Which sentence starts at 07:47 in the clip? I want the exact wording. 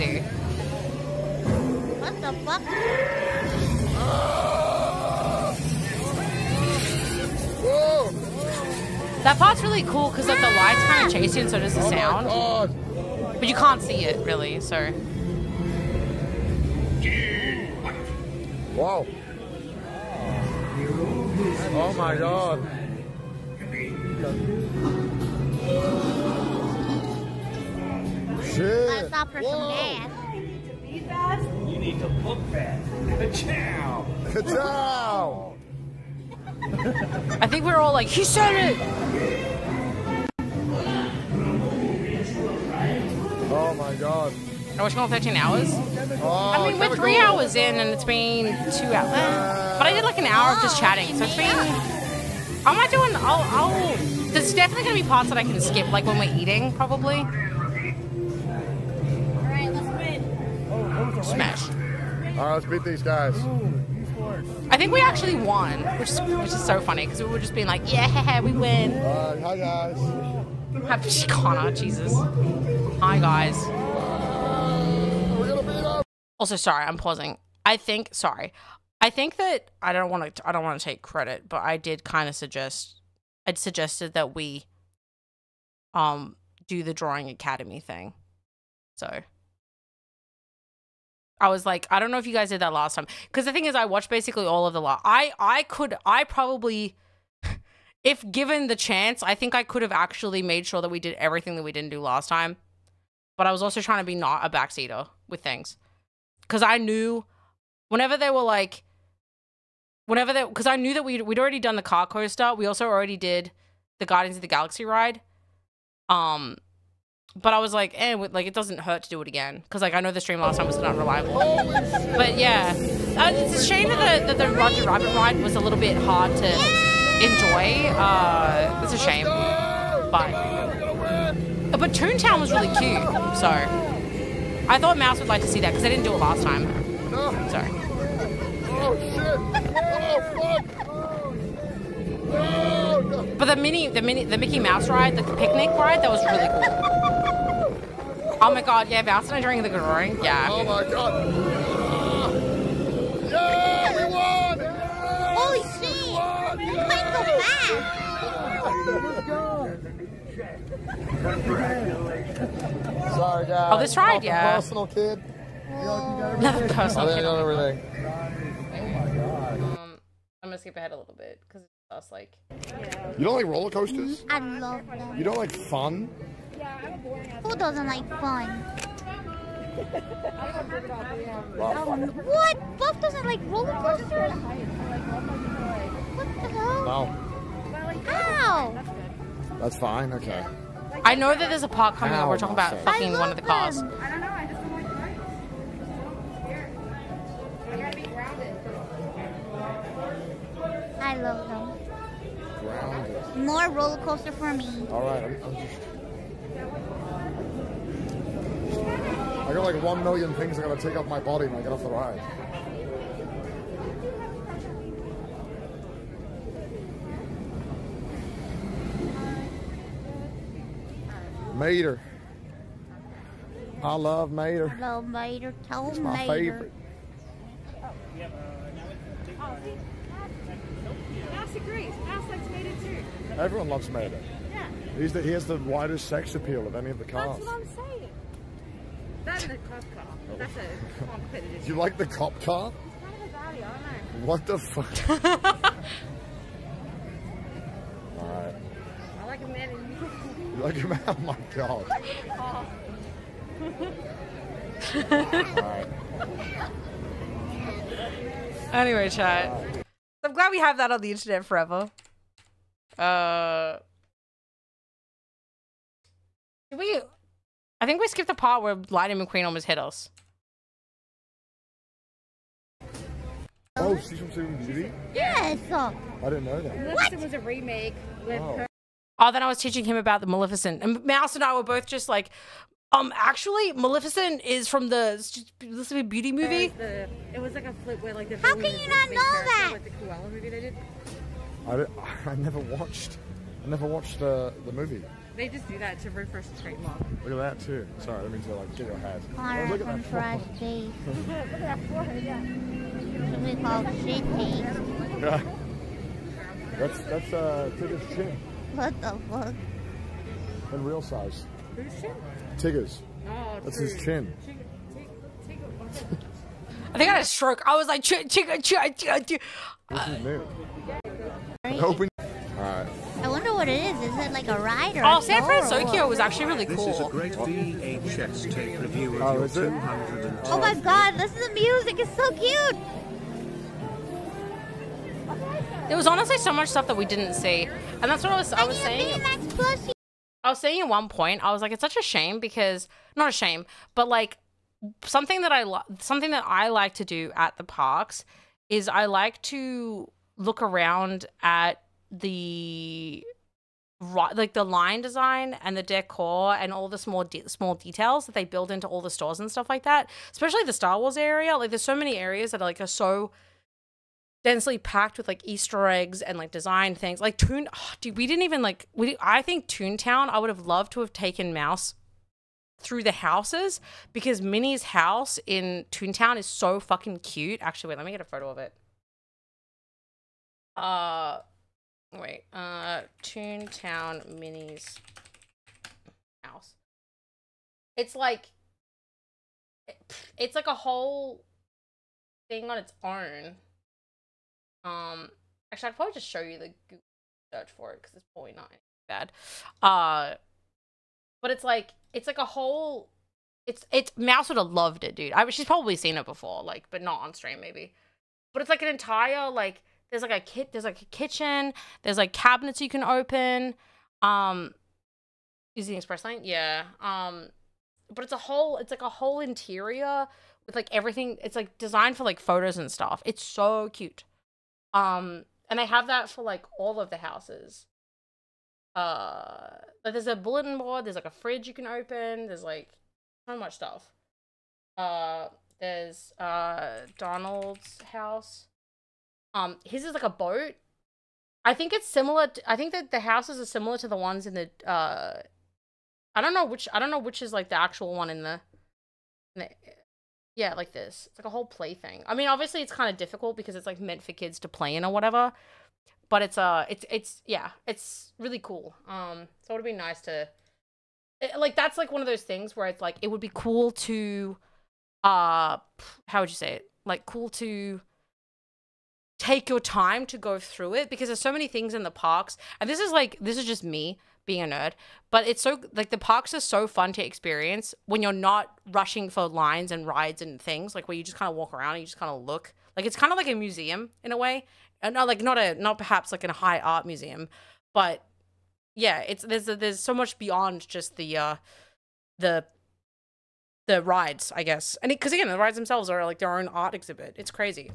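Like cool to take your time to go through it because there's so many things in the parks.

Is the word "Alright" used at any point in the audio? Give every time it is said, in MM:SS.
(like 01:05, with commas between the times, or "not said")
04:08, 05:22.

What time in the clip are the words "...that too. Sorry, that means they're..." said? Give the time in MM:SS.
04:57.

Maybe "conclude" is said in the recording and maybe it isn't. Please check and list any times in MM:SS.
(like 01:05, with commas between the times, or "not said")
not said.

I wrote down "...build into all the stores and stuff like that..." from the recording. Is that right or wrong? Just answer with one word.
right.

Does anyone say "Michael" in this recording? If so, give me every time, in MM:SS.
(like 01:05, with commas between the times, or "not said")
02:39.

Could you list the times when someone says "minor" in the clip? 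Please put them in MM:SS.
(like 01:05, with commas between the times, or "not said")
not said.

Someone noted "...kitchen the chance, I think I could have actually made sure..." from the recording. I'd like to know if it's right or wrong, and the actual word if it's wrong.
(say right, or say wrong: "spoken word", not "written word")
wrong: "given", not "kitchen".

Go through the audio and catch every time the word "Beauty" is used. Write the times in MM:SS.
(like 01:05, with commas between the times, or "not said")
04:34, 04:46.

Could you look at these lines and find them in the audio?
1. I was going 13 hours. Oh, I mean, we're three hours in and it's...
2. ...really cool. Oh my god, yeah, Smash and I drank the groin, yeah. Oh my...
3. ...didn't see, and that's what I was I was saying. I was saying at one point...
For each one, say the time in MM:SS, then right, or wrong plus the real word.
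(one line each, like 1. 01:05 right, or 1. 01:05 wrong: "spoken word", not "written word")
1. 00:44 right
2. 02:26 wrong: "Mouse", not "Smash"
3. 05:37 right.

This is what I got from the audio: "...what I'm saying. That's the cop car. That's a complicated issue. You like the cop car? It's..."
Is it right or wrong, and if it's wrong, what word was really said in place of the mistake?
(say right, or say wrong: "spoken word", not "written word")
right.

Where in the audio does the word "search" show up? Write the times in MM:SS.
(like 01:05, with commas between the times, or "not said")
06:37.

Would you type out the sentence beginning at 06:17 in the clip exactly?
Actually, wait, let me get a photo of it.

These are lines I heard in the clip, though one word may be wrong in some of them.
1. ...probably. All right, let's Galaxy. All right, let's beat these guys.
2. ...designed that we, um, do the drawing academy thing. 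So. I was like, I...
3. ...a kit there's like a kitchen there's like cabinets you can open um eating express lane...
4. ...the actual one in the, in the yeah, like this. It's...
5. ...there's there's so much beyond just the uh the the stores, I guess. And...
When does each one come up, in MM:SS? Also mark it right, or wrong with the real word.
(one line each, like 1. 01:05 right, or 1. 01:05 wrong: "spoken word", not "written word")
1. 00:56 wrong: "Smash", not "Galaxy"
2. 01:23 wrong: "suggested", not "designed"
3. 06:50 wrong: "using", not "eating"
4. 07:27 right
5. 08:09 wrong: "rides", not "stores".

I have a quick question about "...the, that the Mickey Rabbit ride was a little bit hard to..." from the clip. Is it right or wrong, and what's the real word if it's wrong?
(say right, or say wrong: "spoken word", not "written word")
wrong: "Roger", not "Mickey".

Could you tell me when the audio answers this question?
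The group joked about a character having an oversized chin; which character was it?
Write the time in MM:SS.
05:12.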